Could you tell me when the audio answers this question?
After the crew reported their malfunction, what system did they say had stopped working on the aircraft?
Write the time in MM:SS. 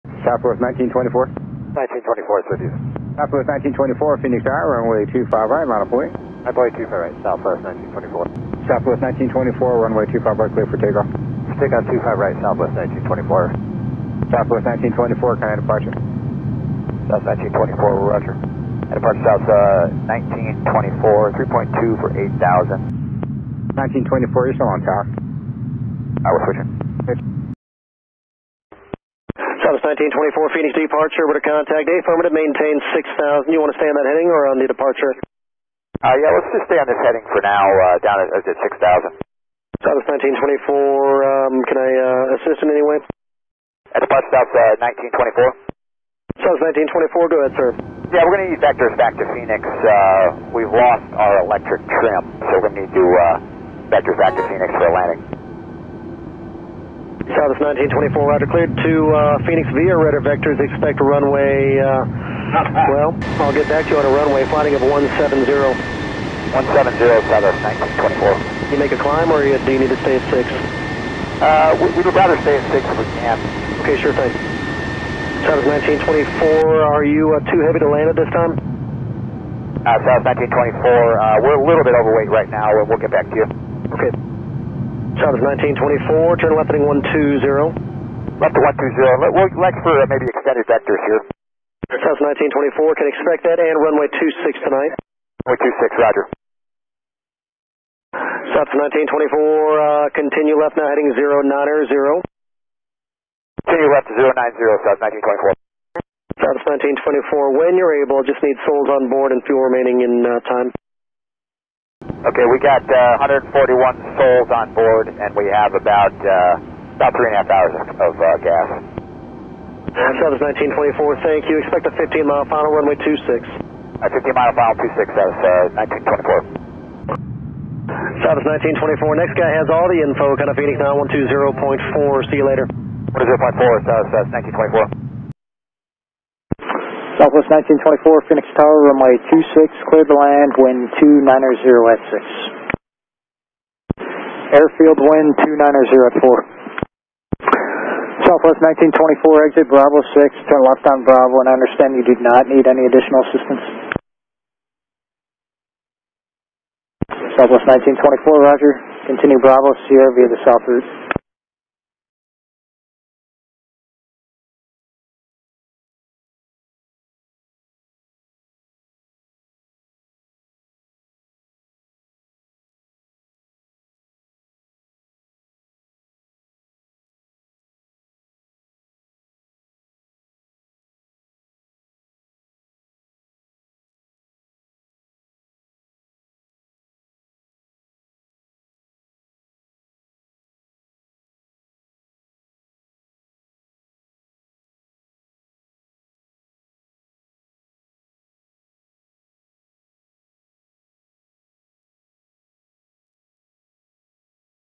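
00:51.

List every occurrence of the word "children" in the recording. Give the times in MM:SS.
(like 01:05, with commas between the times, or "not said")
not said.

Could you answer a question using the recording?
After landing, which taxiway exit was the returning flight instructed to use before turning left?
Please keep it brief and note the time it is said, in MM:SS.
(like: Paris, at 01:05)
Bravo 6, at 02:29.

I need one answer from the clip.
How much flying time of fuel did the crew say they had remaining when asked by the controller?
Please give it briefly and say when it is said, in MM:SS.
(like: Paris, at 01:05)
3.5 hours, at 01:57.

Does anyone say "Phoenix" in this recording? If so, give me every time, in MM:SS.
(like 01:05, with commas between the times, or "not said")
00:04, 00:30, 00:49, 00:54, 00:59, 02:10, 02:18.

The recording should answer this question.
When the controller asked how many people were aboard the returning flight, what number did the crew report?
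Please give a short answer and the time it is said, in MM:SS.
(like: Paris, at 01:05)
141, at 01:53.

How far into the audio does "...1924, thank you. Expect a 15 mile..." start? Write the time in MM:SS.
02:00.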